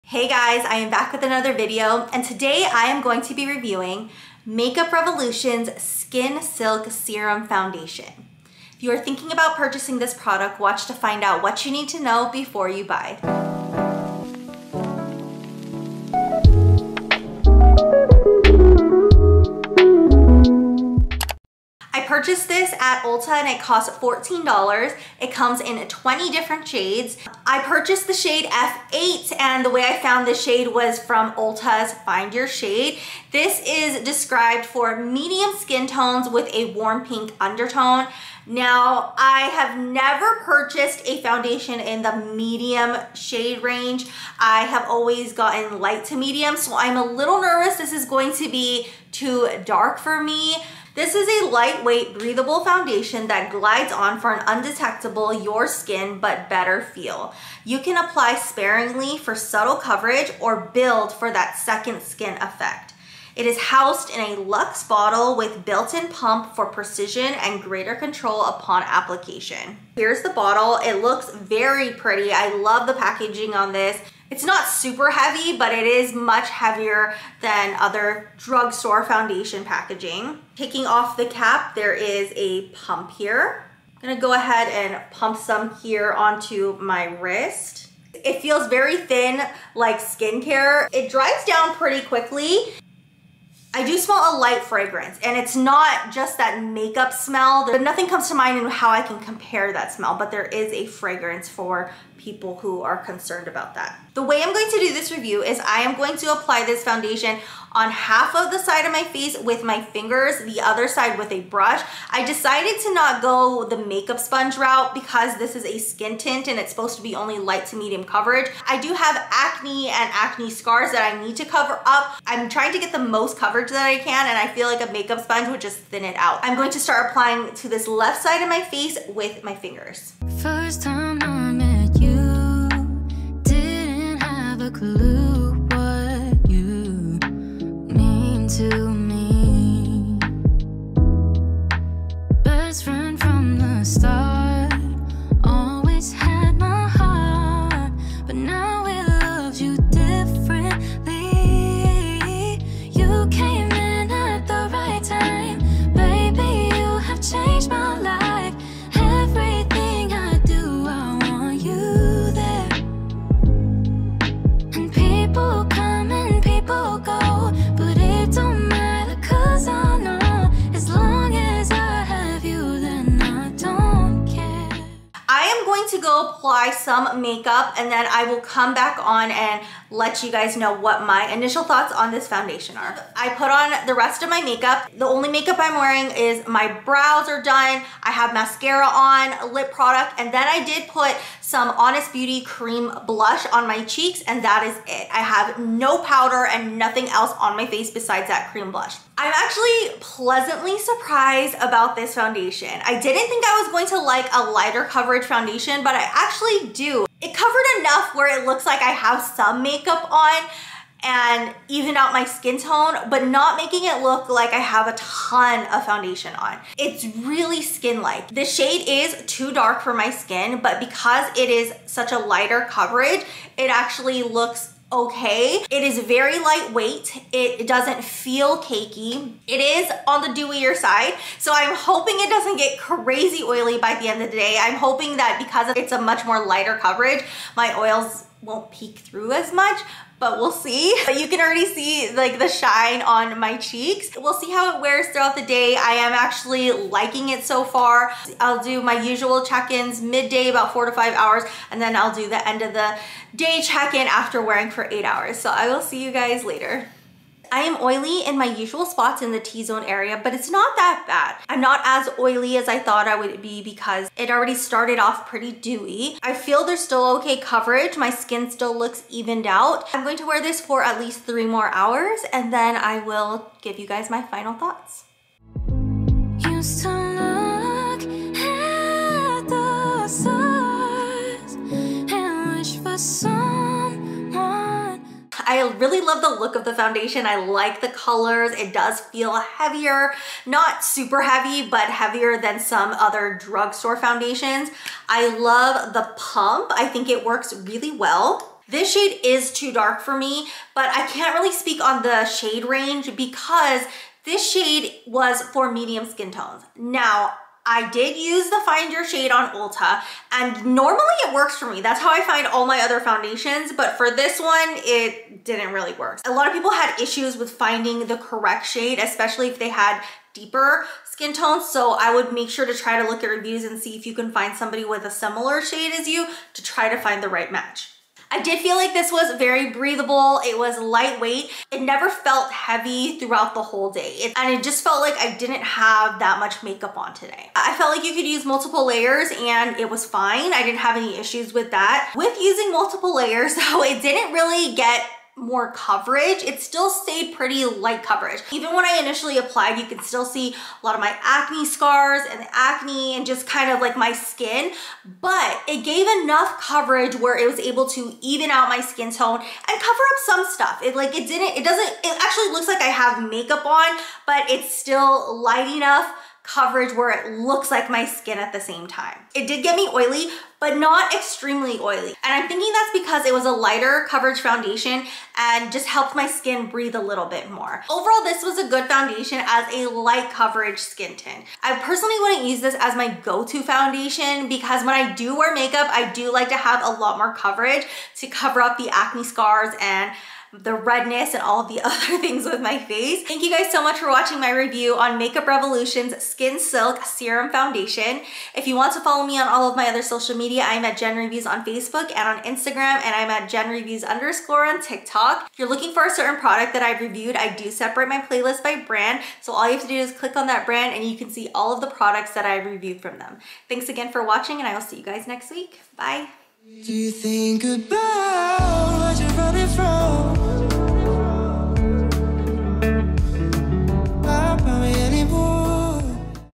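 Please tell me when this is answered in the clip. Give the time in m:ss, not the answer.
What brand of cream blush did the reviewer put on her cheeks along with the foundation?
3:11.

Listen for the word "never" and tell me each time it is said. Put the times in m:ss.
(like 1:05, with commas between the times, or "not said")
0:39, 5:31.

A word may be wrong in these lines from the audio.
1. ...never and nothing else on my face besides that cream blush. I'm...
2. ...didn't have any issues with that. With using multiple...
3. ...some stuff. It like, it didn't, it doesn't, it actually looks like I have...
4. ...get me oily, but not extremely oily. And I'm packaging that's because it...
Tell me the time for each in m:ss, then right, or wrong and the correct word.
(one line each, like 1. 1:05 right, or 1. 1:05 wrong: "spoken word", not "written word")
1. 3:16 wrong: "powder", not "never"
2. 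5:40 right
3. 6:00 right
4. 6:09 wrong: "thinking", not "packaging".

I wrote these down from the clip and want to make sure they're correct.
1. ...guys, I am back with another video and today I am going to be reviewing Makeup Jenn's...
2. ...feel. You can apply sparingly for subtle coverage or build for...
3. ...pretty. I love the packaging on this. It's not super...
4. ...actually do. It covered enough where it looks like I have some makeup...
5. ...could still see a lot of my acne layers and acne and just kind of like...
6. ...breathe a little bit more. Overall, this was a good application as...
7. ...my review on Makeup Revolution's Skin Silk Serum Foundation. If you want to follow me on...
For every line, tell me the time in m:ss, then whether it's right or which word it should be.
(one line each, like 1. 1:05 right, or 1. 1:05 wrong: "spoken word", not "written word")
1. 0:00 wrong: "Revolution", not "Jenn"
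2. 0:56 right
3. 1:11 right
4. 3:26 right
5. 5:49 wrong: "scars", not "layers"
6. 6:16 wrong: "foundation", not "application"
7. 6:34 right.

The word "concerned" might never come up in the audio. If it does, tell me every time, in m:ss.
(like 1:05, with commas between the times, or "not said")
1:42.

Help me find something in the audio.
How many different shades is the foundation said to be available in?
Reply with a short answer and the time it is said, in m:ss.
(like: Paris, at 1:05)
20, at 0:25.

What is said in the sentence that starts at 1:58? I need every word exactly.
I do have acne and acne scars that I need to cover up.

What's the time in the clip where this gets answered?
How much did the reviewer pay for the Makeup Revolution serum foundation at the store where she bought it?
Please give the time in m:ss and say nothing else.
0:24.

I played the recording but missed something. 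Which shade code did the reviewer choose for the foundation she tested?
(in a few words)
F8.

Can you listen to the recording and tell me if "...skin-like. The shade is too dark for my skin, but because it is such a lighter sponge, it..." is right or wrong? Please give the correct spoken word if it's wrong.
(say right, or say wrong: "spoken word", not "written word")
wrong: "coverage", not "sponge".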